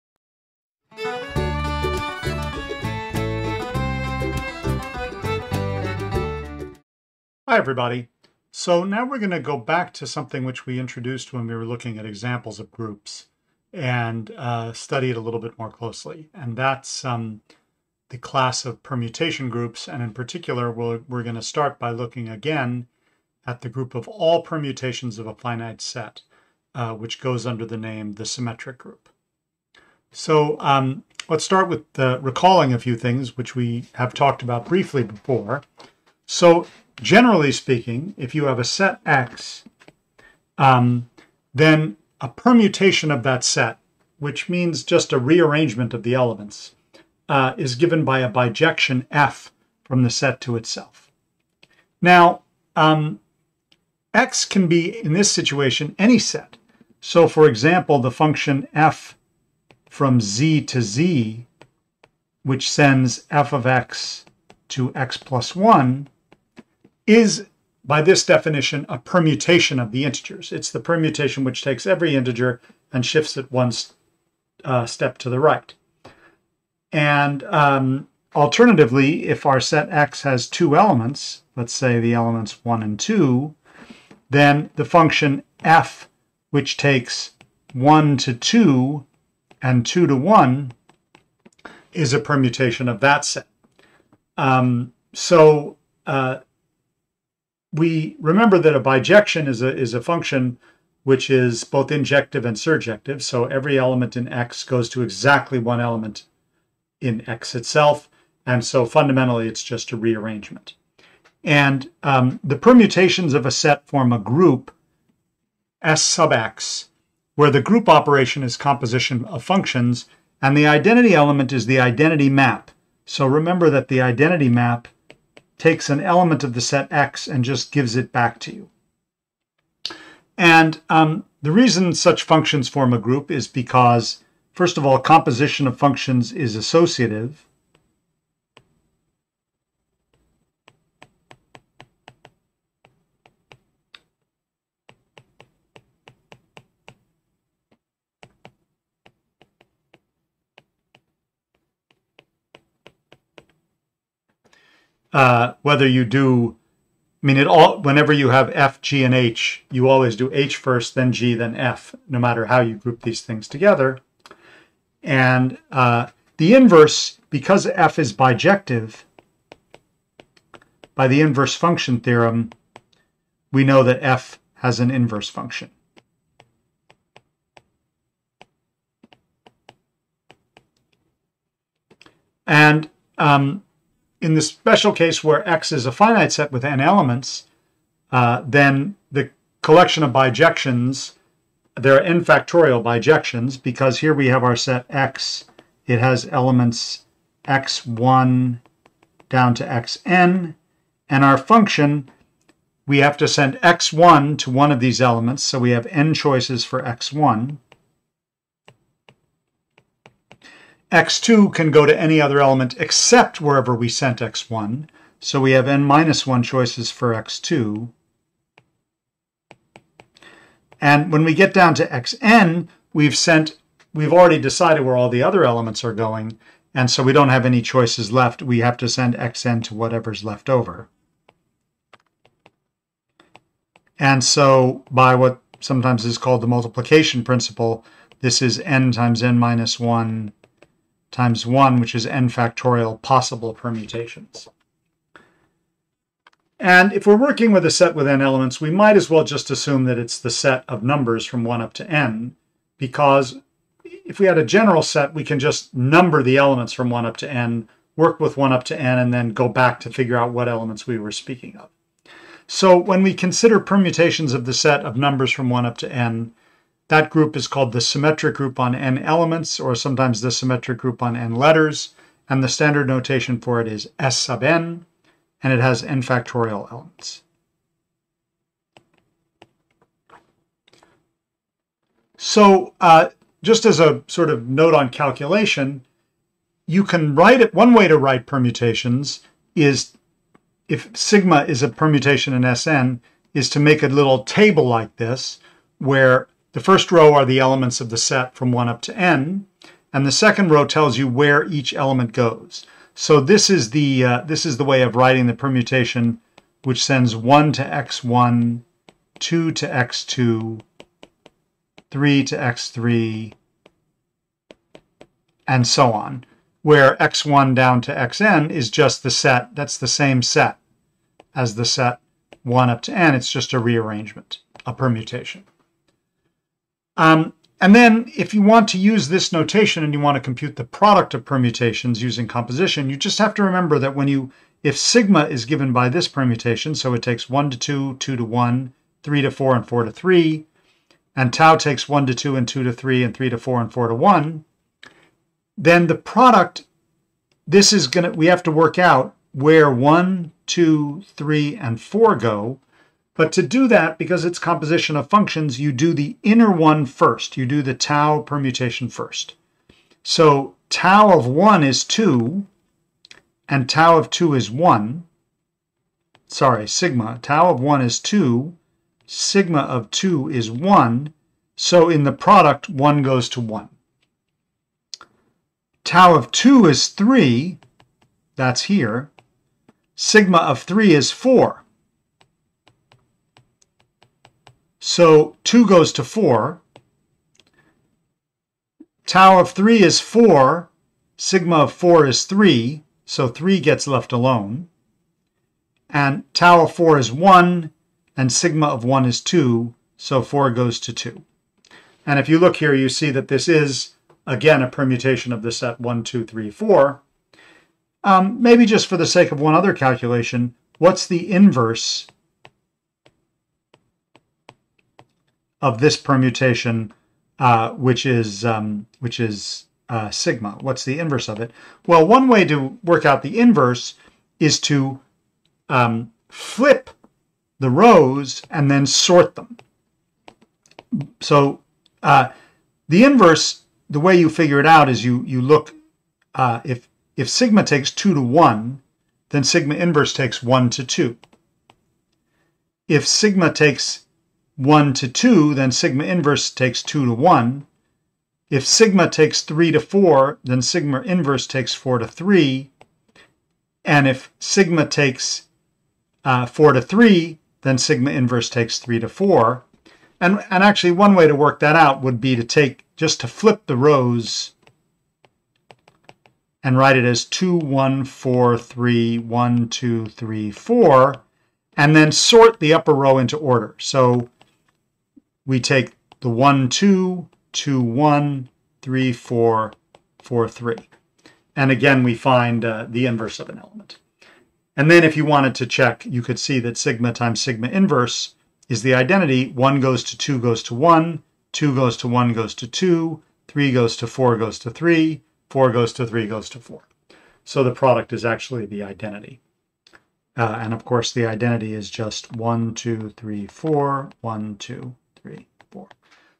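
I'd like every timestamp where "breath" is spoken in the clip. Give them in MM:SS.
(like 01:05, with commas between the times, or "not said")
not said.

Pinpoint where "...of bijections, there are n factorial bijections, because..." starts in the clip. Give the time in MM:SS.
03:10.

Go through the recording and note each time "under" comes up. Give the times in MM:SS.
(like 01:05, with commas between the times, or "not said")
00:27.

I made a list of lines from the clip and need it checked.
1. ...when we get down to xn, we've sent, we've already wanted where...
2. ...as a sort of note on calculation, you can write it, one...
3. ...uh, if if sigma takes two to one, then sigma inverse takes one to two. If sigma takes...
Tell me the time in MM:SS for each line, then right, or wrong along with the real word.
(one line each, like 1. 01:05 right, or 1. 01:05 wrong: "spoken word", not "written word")
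1. 03:41 wrong: "decided", not "wanted"
2. 04:43 right
3. 07:16 right.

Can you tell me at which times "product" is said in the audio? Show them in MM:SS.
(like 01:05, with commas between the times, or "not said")
05:30, 05:45, 06:12, 08:17.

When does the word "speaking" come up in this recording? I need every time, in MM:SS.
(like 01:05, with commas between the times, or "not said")
00:37, 04:21.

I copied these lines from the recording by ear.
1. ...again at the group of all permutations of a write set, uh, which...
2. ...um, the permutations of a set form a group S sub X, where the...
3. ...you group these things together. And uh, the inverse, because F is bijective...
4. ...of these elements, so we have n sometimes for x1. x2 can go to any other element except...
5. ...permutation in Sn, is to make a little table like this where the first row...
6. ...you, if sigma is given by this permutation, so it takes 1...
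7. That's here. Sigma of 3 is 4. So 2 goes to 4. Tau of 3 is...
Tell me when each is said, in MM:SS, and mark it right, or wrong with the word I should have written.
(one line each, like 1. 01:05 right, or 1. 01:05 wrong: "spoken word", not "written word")
1. 00:22 wrong: "finite", not "write"
2. 01:52 right
3. 02:42 right
4. 03:24 wrong: "choices", not "sometimes"
5. 04:51 right
6. 05:34 right
7. 06:18 right.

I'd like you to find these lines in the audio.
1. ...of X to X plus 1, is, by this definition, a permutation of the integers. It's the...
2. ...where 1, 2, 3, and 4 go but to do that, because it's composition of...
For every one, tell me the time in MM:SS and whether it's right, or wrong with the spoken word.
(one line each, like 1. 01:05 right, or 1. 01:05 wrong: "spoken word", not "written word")
1. 01:03 right
2. 05:49 right.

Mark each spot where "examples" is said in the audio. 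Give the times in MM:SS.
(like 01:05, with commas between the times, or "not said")
00:12, 00:57.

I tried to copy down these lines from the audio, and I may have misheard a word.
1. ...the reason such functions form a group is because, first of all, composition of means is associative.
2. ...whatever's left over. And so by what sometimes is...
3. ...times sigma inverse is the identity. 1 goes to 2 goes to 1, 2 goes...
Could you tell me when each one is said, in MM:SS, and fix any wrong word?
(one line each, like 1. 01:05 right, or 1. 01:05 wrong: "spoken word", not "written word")
1. 02:11 wrong: "functions", not "means"
2. 03:49 right
3. 08:07 right.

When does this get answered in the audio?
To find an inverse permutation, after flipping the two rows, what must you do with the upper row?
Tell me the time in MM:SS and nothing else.
07:08.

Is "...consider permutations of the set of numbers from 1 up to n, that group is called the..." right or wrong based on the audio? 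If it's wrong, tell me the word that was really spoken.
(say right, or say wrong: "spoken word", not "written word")
right.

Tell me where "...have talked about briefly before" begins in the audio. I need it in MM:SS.
00:33.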